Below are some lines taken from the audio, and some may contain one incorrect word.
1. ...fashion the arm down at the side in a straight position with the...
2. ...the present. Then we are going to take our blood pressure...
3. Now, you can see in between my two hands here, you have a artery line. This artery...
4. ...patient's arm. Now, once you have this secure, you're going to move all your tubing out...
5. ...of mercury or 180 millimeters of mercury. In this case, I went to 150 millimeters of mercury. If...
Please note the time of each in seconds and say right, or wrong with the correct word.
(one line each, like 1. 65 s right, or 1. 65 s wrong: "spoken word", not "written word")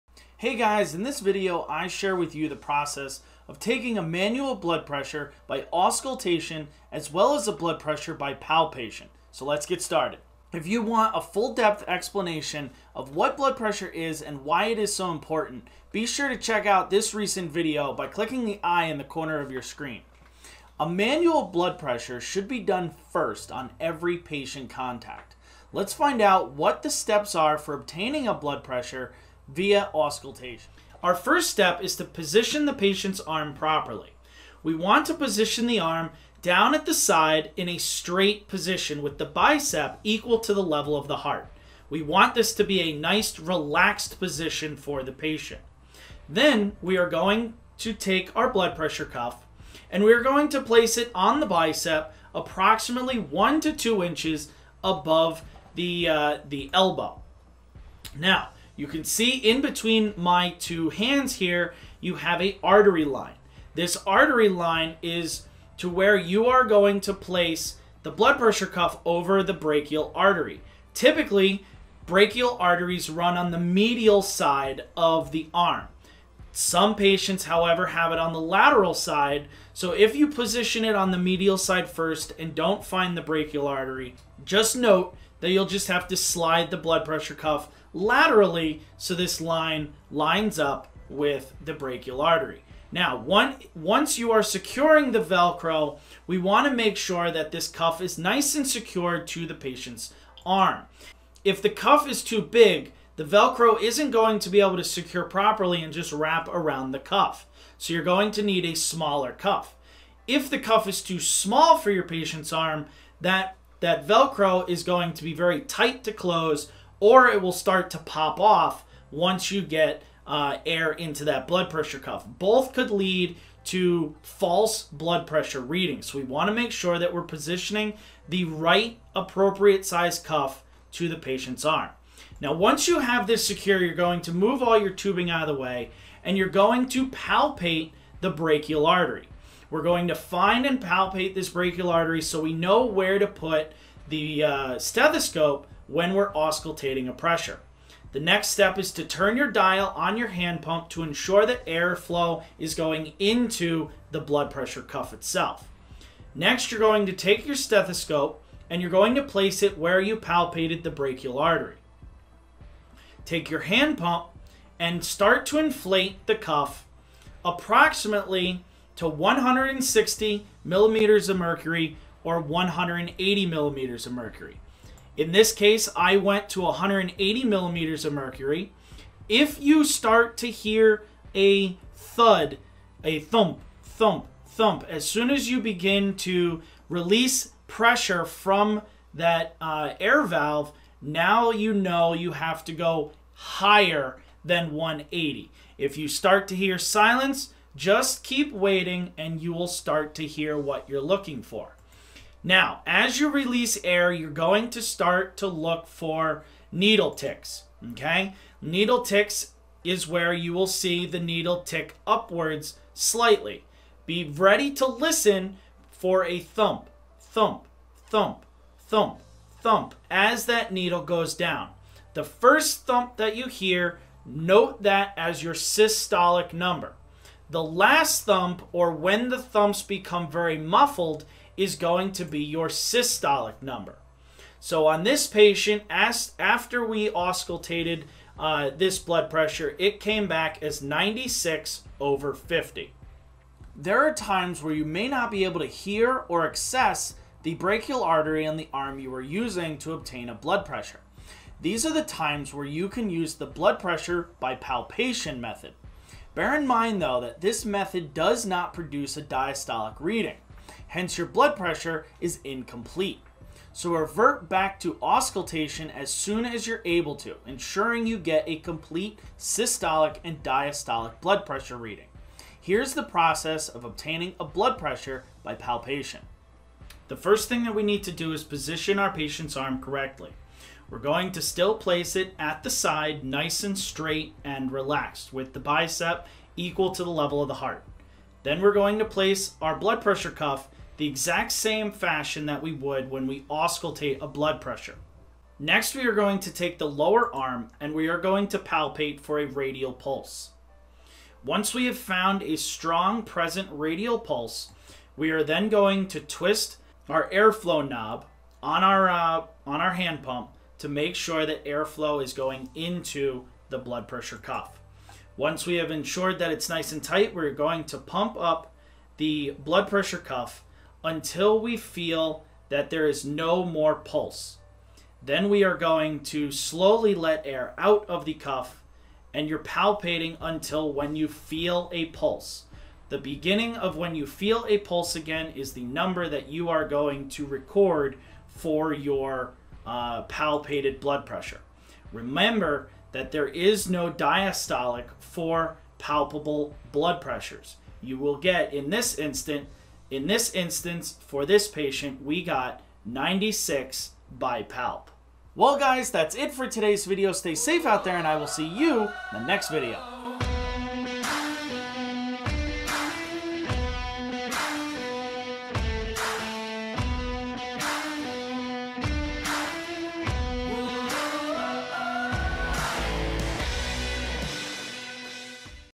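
1. 35 s wrong: "position", not "fashion"
2. 45 s wrong: "patient", not "present"
3. 58 s right
4. 131 s right
5. 171 s wrong: "180", not "150".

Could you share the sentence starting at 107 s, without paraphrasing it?
So you're going to need a smaller cuff.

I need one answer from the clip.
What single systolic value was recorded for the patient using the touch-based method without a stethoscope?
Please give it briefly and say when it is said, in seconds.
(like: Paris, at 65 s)
96, at 353 s.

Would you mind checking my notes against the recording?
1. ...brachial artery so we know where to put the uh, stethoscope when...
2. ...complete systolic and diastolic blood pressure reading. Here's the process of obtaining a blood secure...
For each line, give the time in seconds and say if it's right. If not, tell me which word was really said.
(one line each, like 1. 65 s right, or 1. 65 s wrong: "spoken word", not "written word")
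1. 141 s right
2. 268 s wrong: "pressure", not "secure".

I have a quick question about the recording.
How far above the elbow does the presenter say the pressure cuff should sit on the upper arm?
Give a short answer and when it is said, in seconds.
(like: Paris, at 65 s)
1 to 2 inches, at 53 s.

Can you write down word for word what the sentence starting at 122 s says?
Both could lead to false blood pressure readings.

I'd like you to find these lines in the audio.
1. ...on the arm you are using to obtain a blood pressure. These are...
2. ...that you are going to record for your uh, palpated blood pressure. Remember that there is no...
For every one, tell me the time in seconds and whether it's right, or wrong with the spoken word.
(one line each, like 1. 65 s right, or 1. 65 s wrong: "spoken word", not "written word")
1. 248 s right
2. 336 s right.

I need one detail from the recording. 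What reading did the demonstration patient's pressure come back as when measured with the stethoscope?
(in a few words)
96 over 50.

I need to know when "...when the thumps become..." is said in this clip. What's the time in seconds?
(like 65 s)
228 s.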